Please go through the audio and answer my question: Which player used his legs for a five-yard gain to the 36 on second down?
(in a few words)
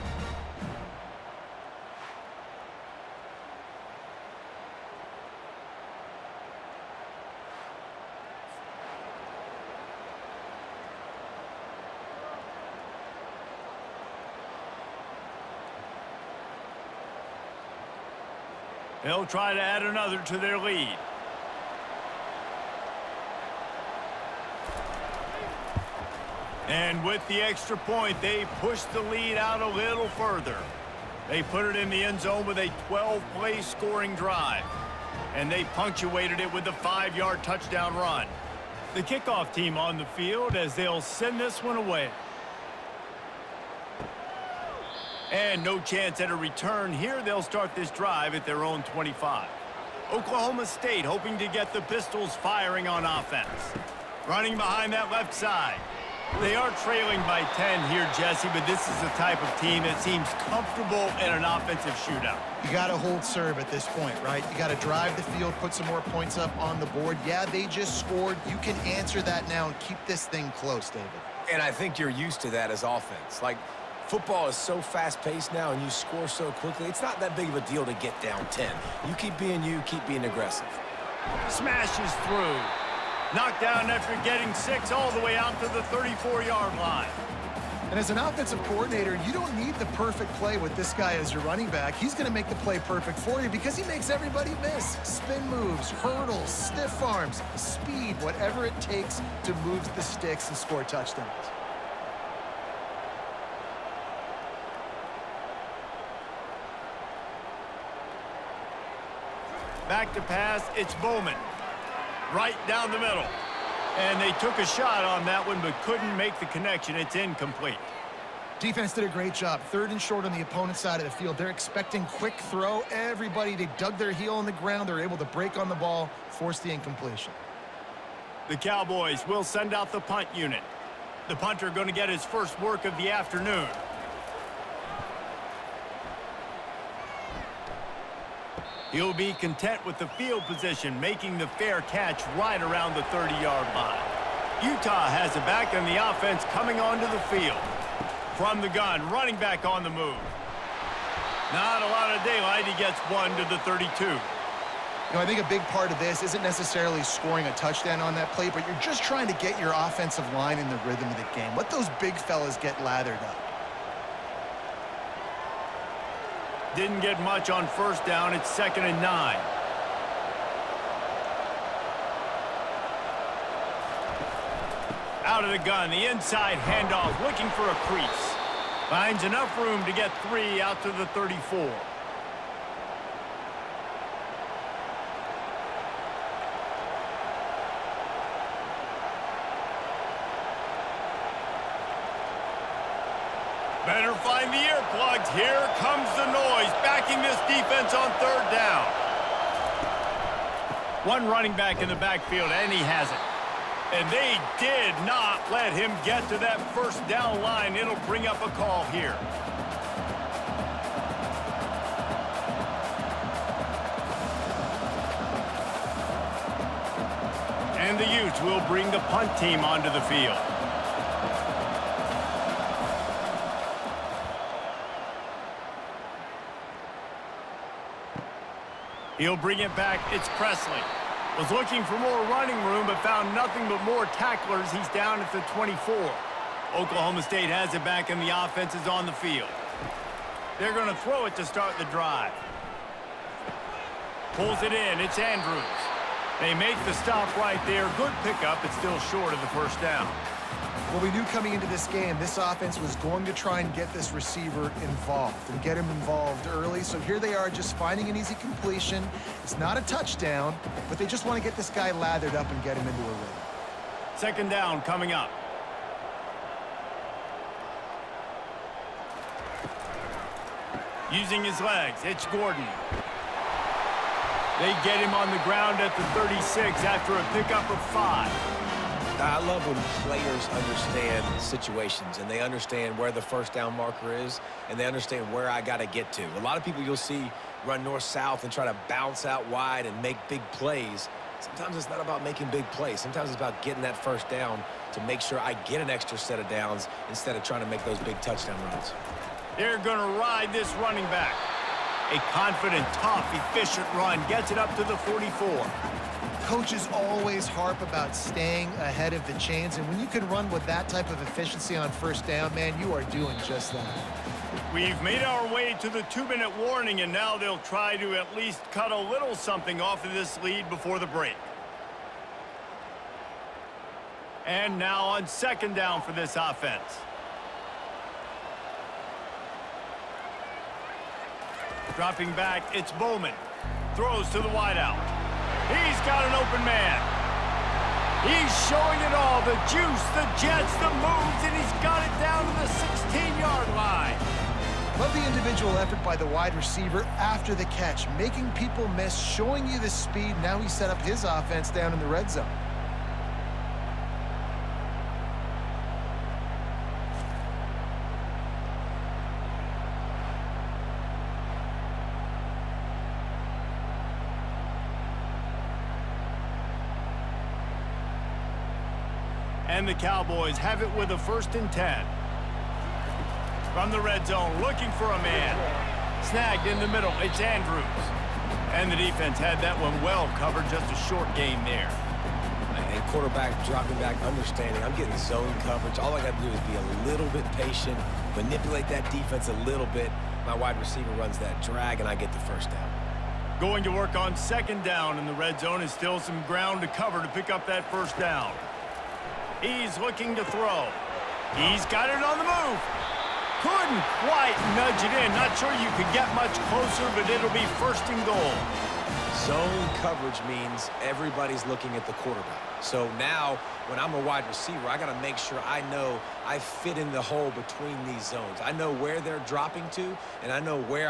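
Gordon.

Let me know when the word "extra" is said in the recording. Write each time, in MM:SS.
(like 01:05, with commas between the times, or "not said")
00:27, 04:55.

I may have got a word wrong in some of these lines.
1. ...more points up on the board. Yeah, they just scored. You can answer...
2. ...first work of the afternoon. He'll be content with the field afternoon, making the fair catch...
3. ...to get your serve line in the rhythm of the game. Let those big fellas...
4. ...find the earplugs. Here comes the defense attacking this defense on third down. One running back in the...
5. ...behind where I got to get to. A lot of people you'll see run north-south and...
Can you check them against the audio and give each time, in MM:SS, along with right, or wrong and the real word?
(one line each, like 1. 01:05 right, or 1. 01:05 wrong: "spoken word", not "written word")
1. 01:05 right
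2. 02:12 wrong: "position", not "afternoon"
3. 02:39 wrong: "offensive", not "serve"
4. 03:14 wrong: "noise", not "defense"
5. 04:44 wrong: "understand", not "behind".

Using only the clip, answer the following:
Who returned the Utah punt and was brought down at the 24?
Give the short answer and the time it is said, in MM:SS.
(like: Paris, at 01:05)
Presley, at 03:50.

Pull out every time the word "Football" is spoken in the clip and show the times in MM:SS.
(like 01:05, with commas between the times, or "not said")
01:14.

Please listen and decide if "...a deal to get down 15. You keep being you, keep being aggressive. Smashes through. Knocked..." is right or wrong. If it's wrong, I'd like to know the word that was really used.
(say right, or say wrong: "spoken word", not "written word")
wrong: "10", not "15".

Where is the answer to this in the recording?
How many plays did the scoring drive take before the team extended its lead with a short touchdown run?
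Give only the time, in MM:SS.
00:32.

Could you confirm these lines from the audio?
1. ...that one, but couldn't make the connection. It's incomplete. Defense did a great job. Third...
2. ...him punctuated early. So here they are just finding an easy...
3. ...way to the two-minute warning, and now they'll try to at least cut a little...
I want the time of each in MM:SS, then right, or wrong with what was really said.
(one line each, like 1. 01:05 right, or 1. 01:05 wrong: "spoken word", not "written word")
1. 01:55 right
2. 04:15 wrong: "involved", not "punctuated"
3. 05:15 right.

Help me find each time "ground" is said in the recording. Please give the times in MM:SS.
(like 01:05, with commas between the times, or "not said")
02:04, 04:35, 06:36.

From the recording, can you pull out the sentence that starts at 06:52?
So now, when I'm a wide receiver, I got to make sure I know I fit in the hole between these zones.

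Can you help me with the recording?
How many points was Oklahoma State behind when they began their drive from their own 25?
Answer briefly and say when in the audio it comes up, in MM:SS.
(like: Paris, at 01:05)
10, at 00:56.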